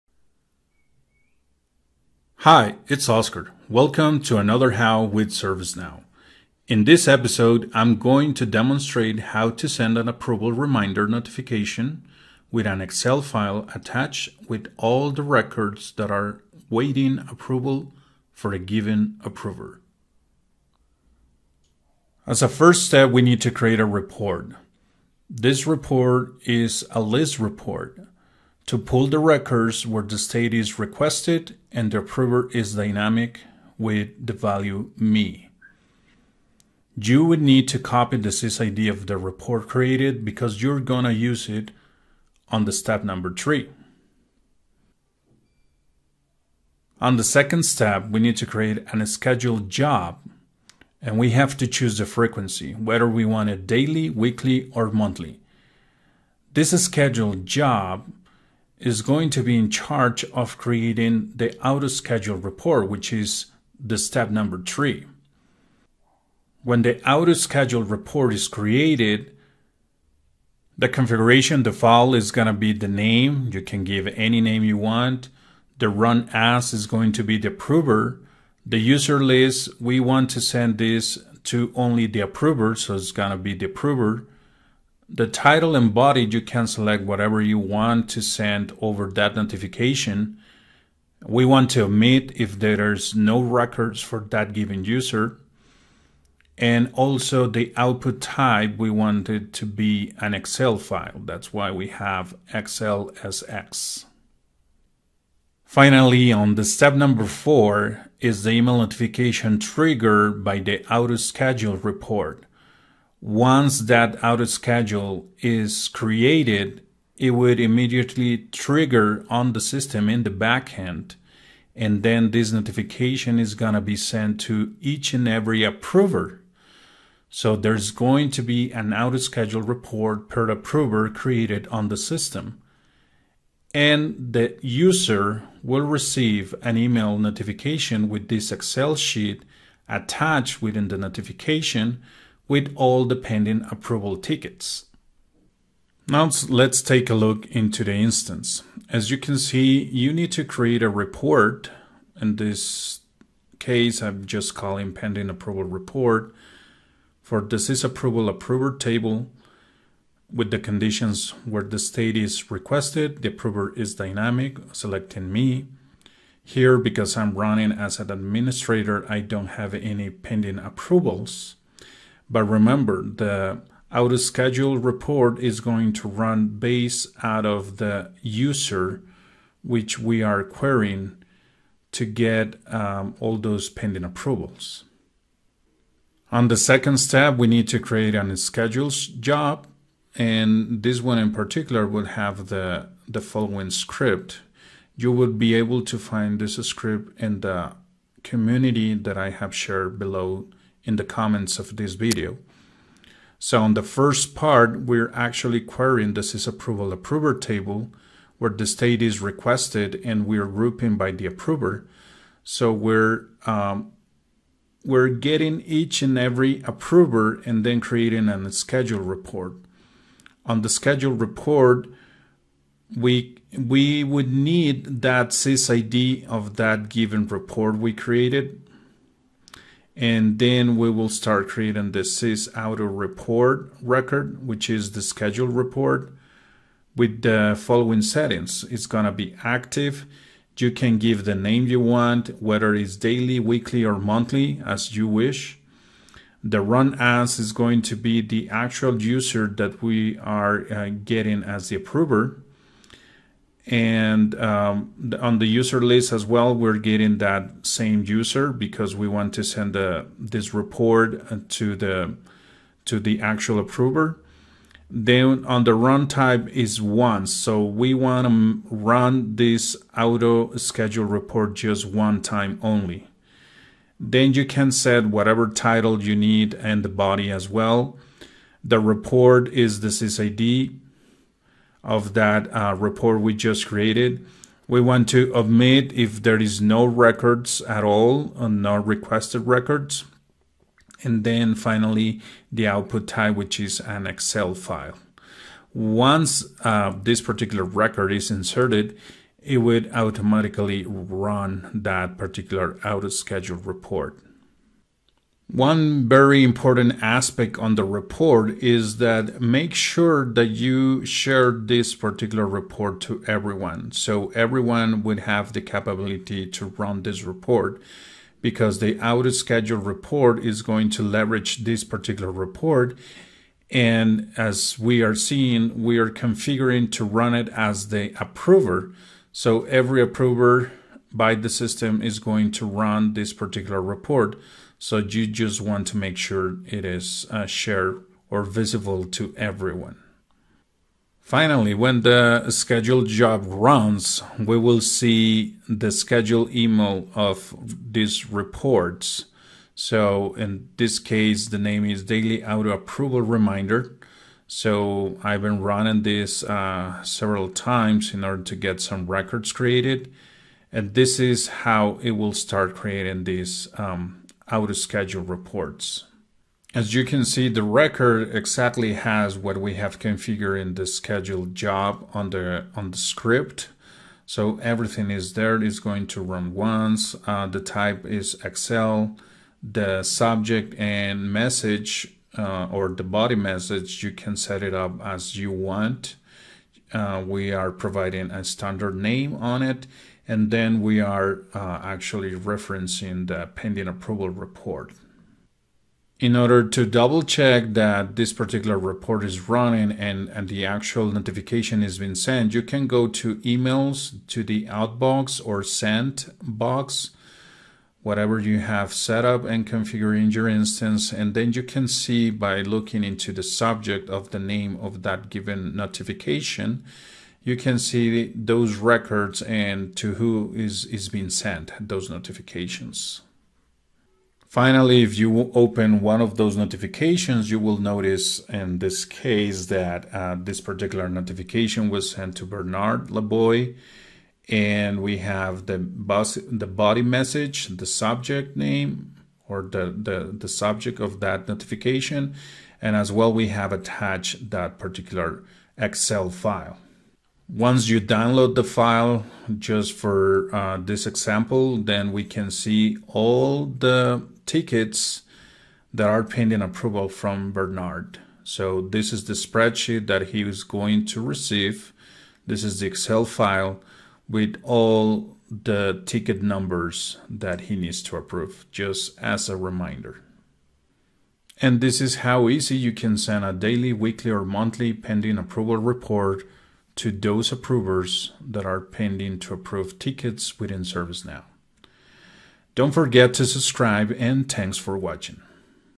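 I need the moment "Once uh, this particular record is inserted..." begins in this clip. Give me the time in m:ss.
4:55.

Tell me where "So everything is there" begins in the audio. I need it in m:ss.
6:14.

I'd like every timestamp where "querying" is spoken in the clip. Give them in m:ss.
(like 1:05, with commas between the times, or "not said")
3:00, 3:25.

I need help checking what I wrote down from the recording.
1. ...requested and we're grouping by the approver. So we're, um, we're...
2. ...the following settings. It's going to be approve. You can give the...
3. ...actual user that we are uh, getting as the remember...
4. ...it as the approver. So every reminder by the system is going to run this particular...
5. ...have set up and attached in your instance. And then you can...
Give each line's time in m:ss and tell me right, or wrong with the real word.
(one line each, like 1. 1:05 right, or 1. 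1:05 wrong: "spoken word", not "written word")
1. 3:29 right
2. 3:57 wrong: "active", not "approve"
3. 4:08 wrong: "approver", not "remember"
4. 5:27 wrong: "approver", not "reminder"
5. 6:48 wrong: "configured", not "attached".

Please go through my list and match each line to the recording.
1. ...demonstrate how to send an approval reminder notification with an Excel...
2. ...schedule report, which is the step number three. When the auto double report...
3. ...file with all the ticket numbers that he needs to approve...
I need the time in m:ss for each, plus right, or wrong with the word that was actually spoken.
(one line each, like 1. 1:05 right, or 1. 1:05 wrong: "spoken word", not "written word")
1. 0:08 right
2. 1:01 wrong: "schedule", not "double"
3. 7:43 right.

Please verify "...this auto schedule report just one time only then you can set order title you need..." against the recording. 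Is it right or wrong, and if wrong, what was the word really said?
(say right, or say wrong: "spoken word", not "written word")
wrong: "whatever", not "order".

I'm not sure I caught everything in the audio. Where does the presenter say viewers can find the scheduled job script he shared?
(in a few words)
the community.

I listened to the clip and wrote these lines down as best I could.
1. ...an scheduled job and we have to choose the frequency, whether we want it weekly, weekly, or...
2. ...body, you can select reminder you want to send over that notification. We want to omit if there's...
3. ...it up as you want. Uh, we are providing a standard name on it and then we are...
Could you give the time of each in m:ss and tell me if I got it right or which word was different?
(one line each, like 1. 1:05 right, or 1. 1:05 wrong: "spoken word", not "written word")
1. 0:48 wrong: "daily", not "weekly"
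2. 1:25 wrong: "whatever", not "reminder"
3. 6:24 right.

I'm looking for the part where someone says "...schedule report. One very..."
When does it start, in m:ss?
5:03.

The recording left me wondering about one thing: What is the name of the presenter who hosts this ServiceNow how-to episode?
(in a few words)
Oscar.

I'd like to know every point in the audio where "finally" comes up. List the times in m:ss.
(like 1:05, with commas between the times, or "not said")
1:45, 4:51, 5:41, 7:04.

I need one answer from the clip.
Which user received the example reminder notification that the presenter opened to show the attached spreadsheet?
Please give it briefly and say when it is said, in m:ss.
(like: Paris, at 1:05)
Bernard Laboy, at 7:12.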